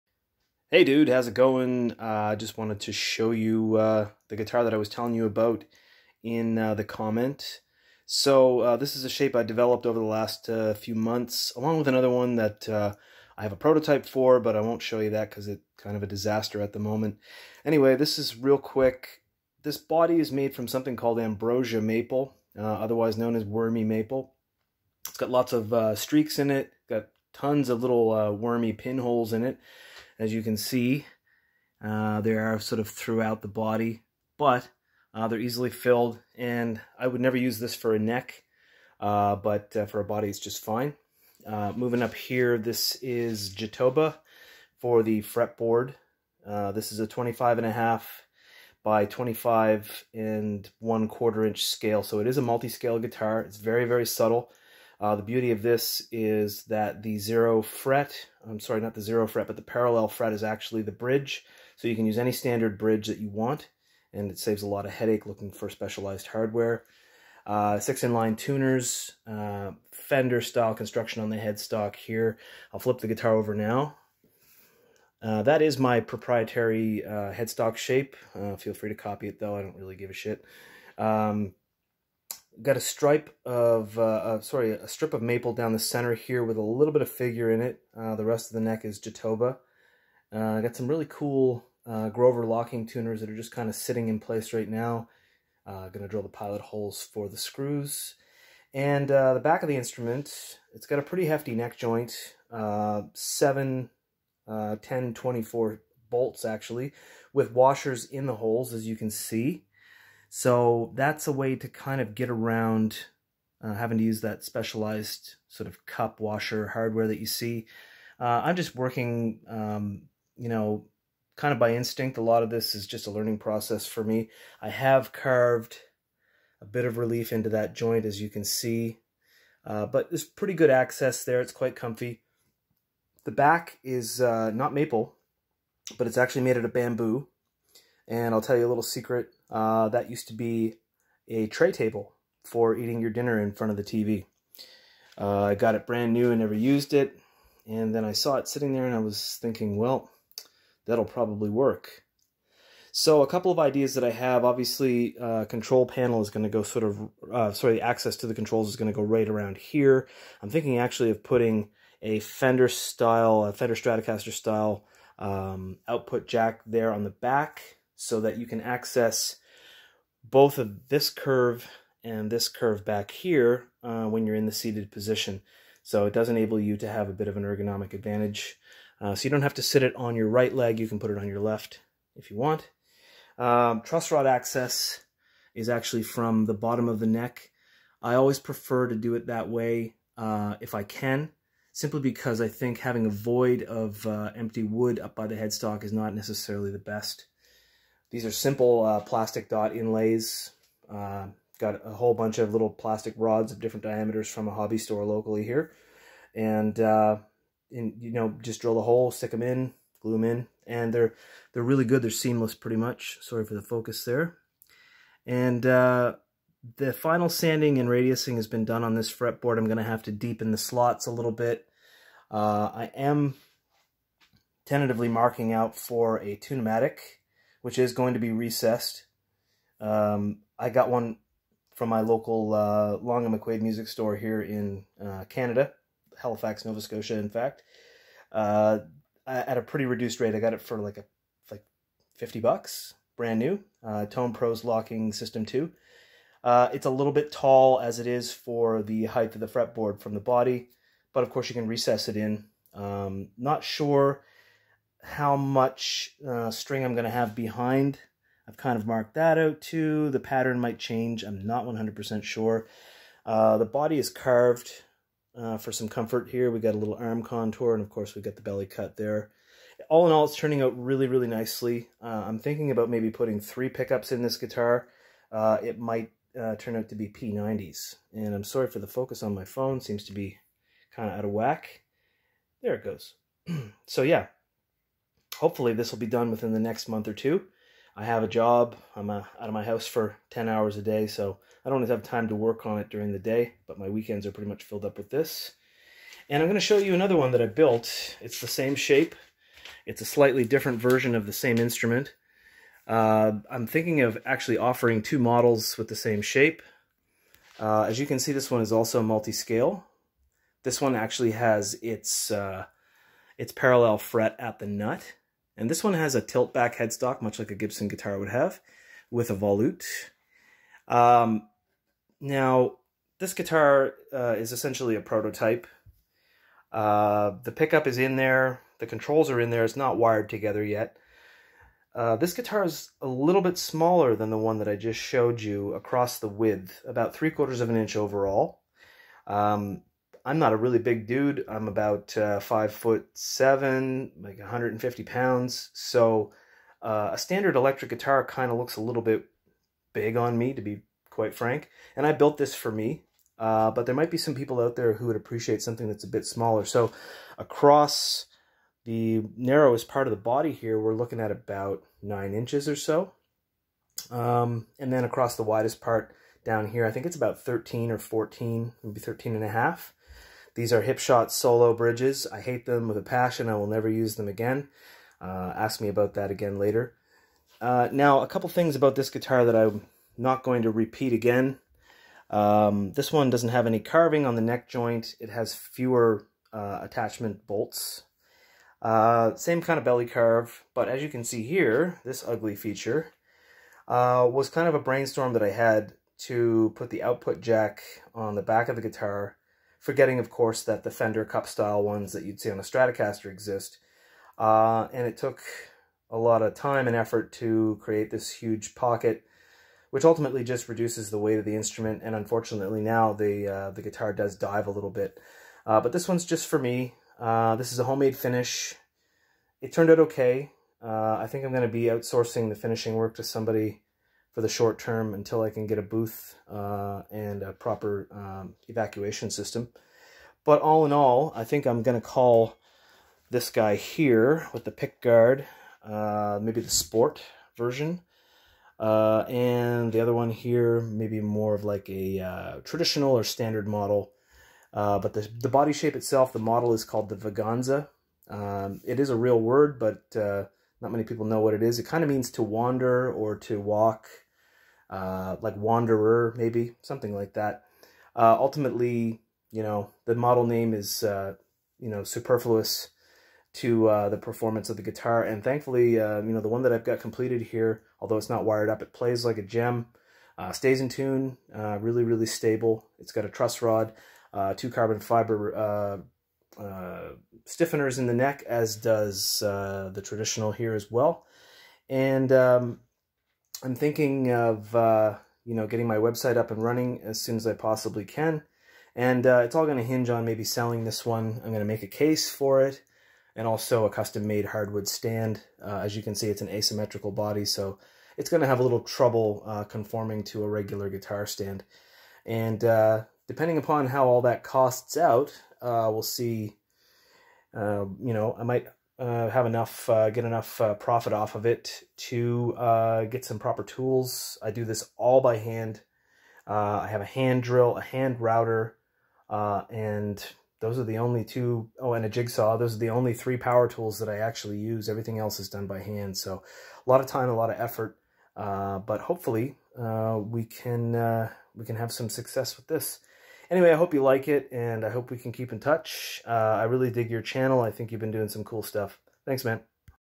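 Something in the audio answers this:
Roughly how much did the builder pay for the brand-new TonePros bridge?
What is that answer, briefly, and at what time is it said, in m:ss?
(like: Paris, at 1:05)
50 bucks, at 4:02.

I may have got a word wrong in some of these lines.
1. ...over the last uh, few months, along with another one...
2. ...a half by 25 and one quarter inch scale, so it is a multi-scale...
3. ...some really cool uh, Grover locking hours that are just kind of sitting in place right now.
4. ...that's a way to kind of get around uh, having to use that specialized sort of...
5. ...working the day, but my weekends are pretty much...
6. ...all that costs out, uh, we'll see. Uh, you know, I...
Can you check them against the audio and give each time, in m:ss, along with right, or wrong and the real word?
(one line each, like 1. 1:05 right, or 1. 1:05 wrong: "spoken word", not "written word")
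1. 0:09 right
2. 0:47 right
3. 1:30 wrong: "tuners", not "hours"
4. 1:50 right
5. 4:52 wrong: "during", not "working"
6. 8:24 right.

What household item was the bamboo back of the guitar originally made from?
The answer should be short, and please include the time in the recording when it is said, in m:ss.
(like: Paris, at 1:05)
tray table, at 2:21.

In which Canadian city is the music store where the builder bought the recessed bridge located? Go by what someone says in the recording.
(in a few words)
Halifax.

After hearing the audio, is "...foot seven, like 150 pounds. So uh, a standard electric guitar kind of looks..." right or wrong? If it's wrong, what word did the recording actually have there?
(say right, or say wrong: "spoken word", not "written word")
right.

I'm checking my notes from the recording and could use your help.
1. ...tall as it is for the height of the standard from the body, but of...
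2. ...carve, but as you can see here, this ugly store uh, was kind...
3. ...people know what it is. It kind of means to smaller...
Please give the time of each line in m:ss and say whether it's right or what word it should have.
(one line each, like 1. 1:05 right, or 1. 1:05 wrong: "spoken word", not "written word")
1. 4:07 wrong: "fretboard", not "standard"
2. 6:30 wrong: "feature", not "store"
3. 7:31 wrong: "wander", not "smaller".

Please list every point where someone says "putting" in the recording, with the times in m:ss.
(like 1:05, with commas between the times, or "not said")
2:41, 4:33.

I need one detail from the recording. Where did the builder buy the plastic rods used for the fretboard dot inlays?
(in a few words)
hobby store.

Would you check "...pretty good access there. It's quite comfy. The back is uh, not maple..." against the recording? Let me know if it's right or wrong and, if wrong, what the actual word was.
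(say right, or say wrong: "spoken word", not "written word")
right.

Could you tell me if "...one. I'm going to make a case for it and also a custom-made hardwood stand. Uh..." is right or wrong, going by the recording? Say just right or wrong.
right.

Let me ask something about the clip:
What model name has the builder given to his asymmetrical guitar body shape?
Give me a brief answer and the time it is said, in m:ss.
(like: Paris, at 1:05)
Vaganza, at 7:27.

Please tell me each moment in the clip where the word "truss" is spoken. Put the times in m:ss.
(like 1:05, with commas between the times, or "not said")
3:03, 7:53.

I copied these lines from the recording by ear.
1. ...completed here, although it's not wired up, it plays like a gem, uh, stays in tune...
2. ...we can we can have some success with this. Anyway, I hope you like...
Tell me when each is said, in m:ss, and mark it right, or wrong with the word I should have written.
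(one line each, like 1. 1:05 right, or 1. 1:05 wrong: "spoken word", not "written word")
1. 7:46 right
2. 8:49 right.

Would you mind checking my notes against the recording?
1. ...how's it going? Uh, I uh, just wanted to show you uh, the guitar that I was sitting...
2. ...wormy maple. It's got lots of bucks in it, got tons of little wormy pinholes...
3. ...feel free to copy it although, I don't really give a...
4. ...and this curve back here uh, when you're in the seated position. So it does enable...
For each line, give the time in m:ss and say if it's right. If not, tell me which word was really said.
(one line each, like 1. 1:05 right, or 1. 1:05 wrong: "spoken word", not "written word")
1. 0:01 wrong: "telling", not "sitting"
2. 0:23 wrong: "streaks", not "bucks"
3. 1:18 wrong: "though", not "although"
4. 2:52 right.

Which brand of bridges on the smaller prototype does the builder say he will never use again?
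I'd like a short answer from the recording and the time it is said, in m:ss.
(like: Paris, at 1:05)
Hipshot Solo, at 6:10.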